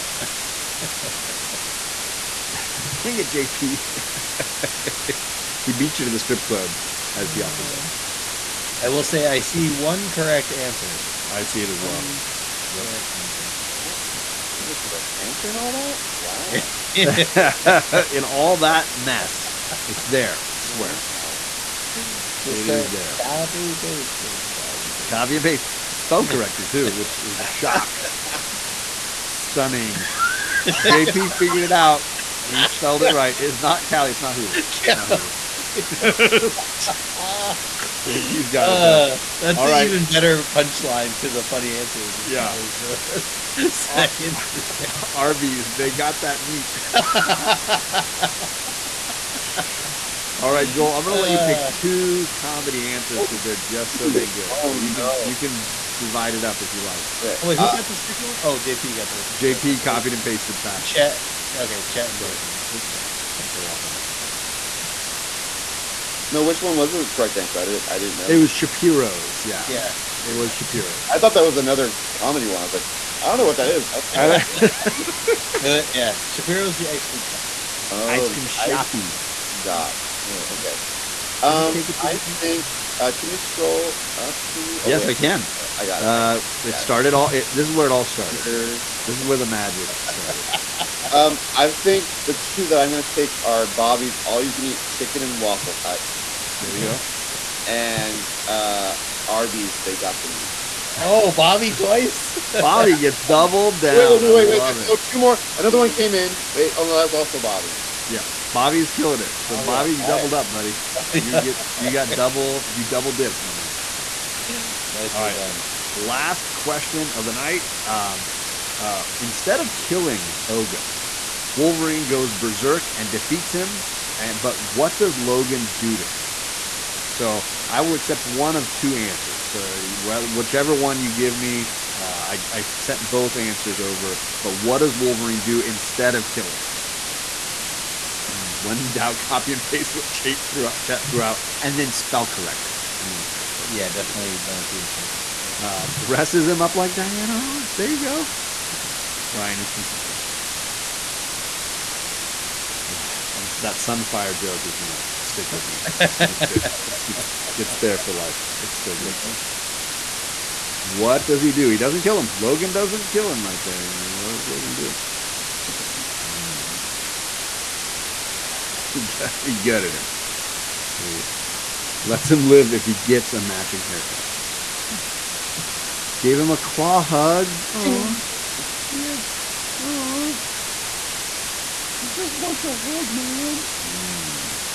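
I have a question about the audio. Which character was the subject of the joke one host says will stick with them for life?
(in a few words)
Sunfire.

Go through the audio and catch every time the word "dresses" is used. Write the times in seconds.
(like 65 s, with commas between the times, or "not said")
145 s.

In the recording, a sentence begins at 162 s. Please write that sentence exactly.
Logan doesn't kill him right there.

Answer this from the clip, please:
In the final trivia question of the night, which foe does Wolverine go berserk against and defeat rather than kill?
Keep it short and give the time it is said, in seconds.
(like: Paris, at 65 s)
Ogun, at 120 s.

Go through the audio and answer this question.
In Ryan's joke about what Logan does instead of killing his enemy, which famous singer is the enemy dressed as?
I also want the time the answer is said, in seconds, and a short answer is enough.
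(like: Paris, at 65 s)
Diana Ross, at 146 s.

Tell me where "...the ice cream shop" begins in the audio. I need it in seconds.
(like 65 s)
76 s.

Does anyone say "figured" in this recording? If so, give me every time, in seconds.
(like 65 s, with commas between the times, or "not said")
31 s.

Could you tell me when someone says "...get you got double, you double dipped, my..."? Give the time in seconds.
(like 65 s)
111 s.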